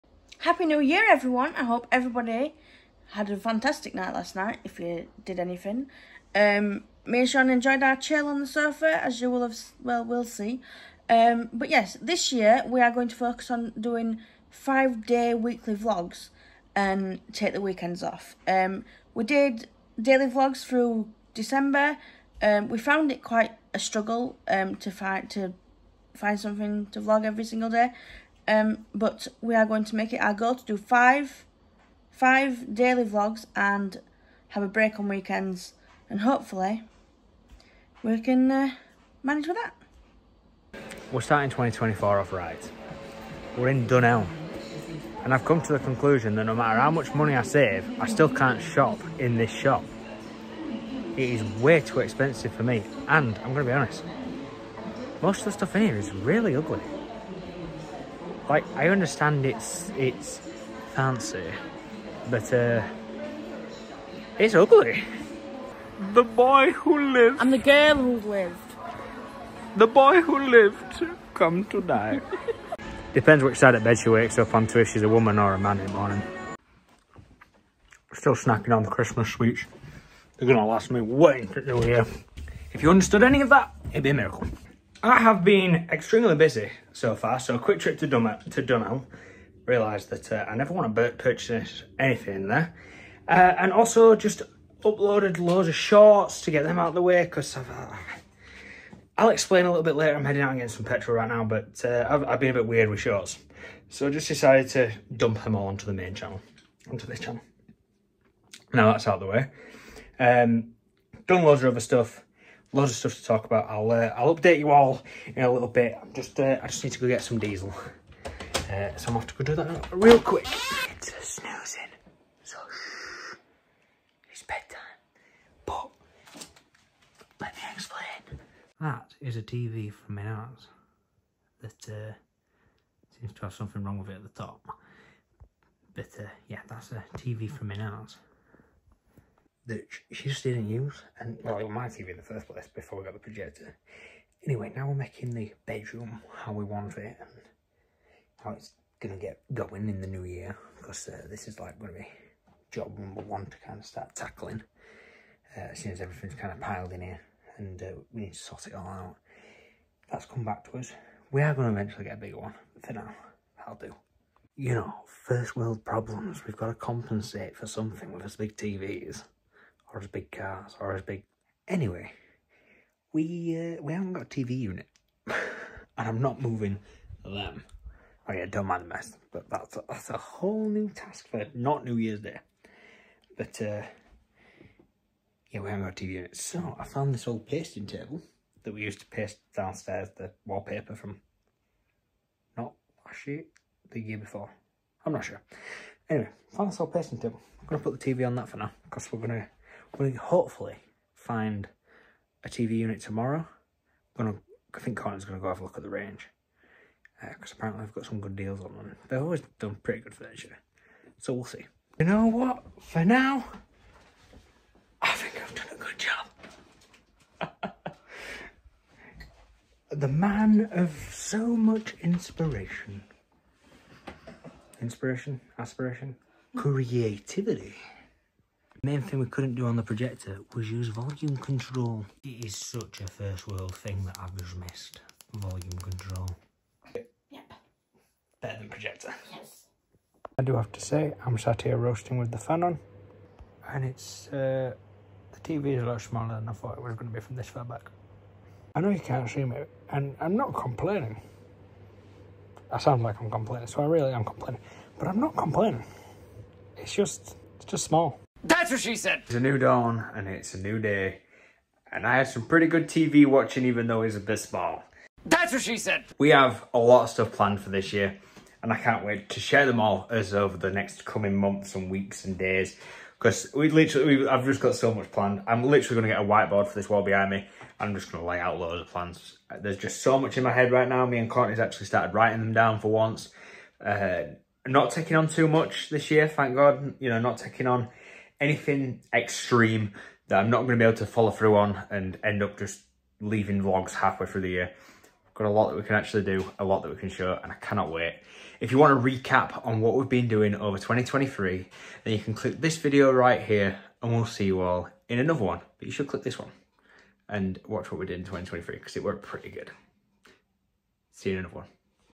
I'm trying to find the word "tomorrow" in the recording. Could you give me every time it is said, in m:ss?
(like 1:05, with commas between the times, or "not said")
3:23.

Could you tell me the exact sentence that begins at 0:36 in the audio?
And hopefully we can uh, manage with that.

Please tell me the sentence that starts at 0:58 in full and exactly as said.
Like, I understand it's it's fancy, but uh, it's ugly.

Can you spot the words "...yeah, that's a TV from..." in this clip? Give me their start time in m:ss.
2:16.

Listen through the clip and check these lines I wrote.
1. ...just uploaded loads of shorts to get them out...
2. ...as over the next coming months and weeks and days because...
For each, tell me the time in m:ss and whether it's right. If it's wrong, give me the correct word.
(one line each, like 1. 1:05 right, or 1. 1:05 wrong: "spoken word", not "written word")
1. 1:34 right
2. 4:30 right.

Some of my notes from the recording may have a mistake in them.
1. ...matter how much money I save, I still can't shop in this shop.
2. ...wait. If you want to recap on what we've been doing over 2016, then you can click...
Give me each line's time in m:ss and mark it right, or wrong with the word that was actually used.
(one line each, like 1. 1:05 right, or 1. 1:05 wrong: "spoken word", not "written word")
1. 0:46 right
2. 4:57 wrong: "2023", not "2016".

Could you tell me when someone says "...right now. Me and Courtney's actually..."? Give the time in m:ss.
4:40.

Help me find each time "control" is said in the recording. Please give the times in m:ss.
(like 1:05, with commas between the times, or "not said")
3:51, 3:55.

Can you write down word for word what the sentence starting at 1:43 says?
So I just decided to dump them all onto the main channel, onto this channel.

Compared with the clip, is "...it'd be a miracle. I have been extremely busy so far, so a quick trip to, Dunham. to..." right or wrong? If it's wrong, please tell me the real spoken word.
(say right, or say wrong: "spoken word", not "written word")
right.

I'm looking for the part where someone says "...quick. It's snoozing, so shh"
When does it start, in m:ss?
2:00.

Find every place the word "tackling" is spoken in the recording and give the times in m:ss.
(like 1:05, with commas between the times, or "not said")
2:34.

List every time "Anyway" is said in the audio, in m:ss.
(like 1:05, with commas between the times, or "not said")
2:24, 2:51, 3:16.